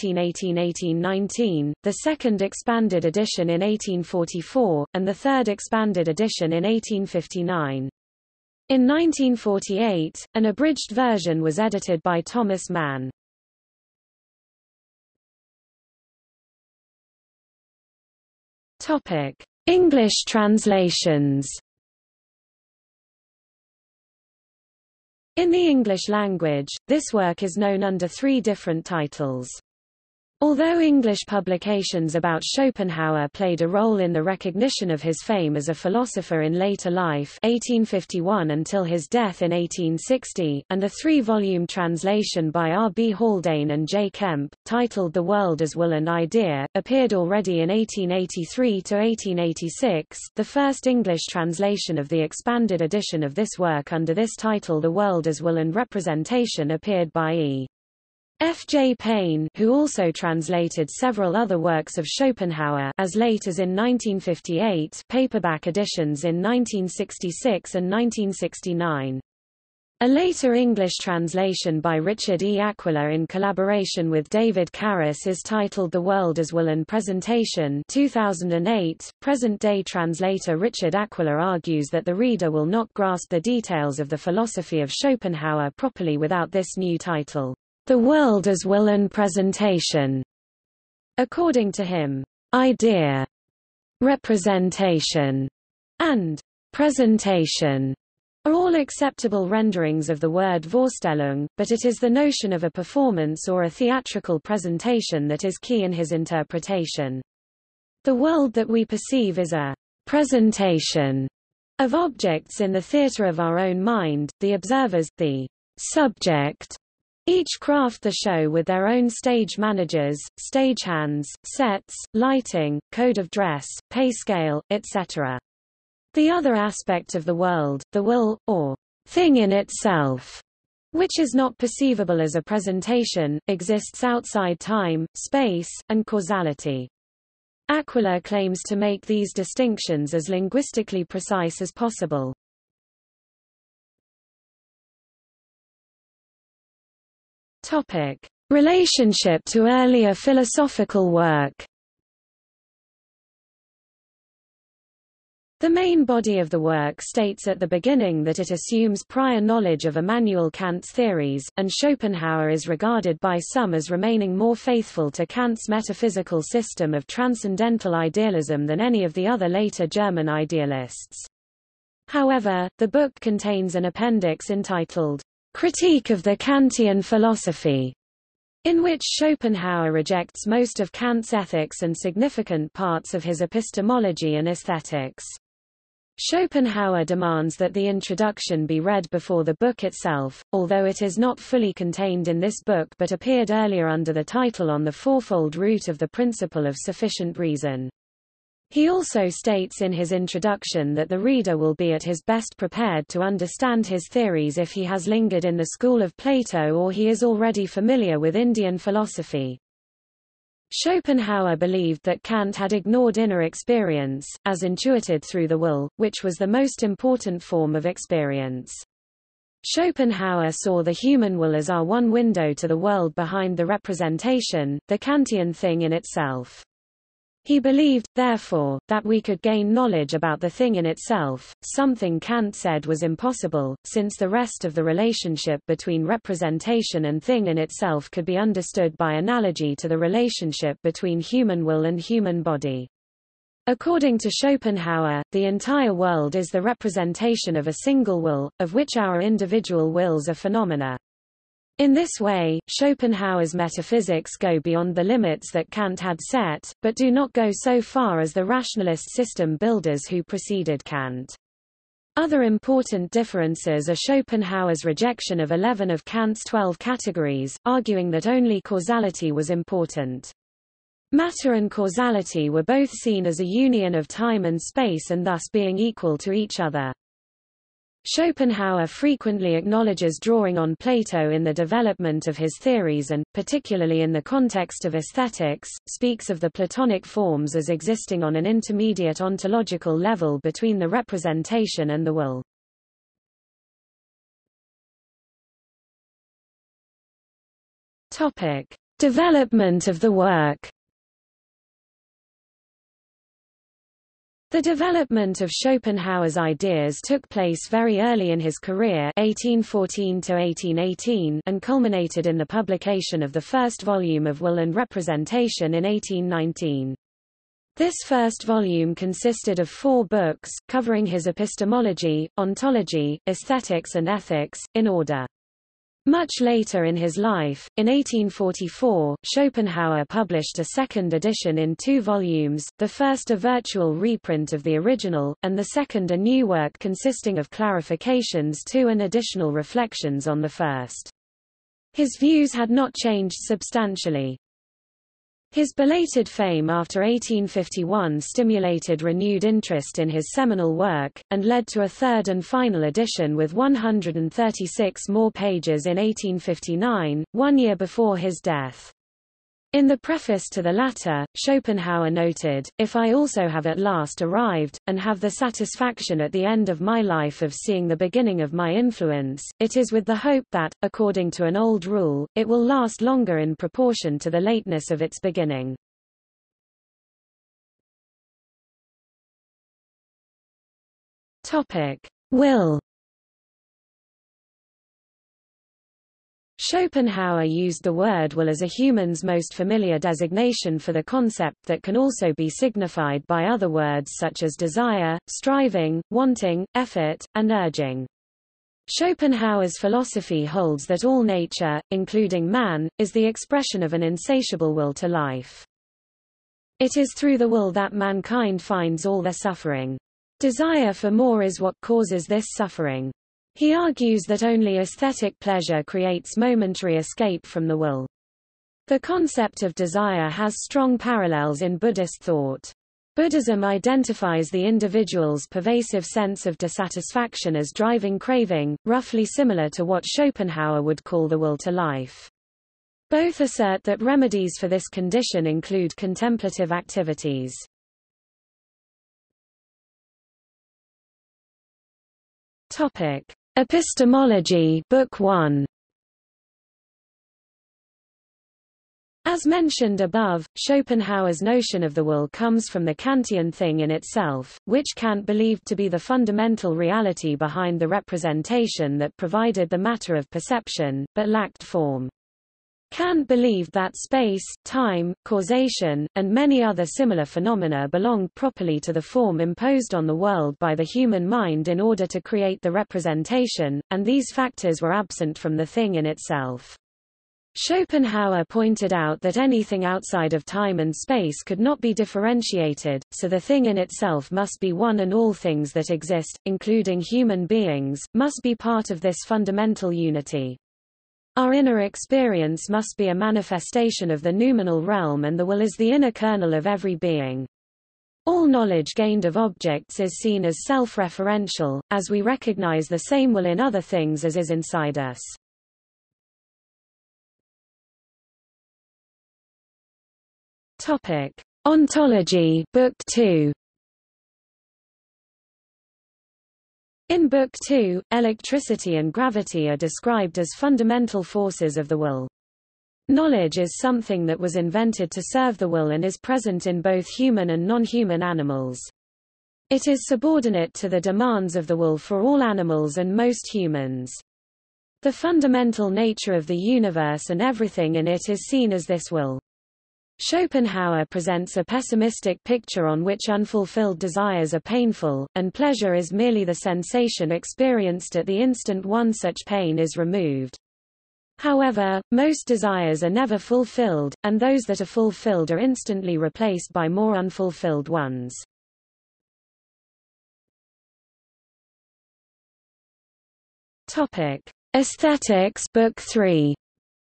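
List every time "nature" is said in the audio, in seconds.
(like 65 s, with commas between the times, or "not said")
401 s, 535 s.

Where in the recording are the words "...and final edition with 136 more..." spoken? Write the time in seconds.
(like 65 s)
352 s.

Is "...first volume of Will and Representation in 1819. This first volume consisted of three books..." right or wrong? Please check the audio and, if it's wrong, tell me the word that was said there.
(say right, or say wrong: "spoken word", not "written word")
wrong: "four", not "three".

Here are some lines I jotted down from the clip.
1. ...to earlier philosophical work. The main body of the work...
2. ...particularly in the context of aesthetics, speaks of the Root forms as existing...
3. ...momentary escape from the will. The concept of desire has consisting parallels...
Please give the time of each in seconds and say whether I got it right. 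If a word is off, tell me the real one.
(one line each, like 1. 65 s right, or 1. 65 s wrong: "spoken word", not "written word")
1. 149 s right
2. 283 s wrong: "Platonic", not "Root"
3. 416 s wrong: "strong", not "consisting".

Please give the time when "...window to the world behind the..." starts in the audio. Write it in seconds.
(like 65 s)
222 s.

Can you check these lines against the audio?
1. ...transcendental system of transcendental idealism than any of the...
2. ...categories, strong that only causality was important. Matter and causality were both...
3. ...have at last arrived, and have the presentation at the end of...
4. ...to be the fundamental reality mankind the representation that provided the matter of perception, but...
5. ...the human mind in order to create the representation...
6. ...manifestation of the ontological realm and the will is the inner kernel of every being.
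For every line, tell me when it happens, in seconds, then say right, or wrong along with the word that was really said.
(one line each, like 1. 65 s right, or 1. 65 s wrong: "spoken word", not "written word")
1. 165 s wrong: "metaphysical", not "transcendental"
2. 266 s wrong: "arguing", not "strong"
3. 363 s wrong: "satisfaction", not "presentation"
4. 455 s wrong: "behind", not "mankind"
5. 470 s right
6. 493 s wrong: "noumenal", not "ontological".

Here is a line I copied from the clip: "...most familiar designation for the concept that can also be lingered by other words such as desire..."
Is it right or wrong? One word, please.
wrong.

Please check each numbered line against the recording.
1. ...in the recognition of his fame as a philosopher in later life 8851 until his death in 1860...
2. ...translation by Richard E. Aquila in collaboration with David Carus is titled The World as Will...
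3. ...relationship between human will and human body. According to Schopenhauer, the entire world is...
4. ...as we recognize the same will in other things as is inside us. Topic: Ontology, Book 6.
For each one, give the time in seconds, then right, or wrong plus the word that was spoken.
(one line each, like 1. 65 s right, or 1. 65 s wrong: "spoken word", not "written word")
1. 33 s wrong: "1851", not "8851"
2. 71 s right
3. 239 s right
4. 501 s wrong: "2", not "6".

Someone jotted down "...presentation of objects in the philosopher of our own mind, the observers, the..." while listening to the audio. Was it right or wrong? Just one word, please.
wrong.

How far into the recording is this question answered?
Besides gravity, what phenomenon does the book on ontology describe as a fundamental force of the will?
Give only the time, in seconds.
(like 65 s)
518 s.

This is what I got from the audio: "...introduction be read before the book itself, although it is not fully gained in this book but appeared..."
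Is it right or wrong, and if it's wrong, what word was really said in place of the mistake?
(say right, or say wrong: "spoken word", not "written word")
wrong: "contained", not "gained".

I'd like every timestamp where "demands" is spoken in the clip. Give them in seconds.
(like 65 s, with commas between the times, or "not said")
187 s, 530 s.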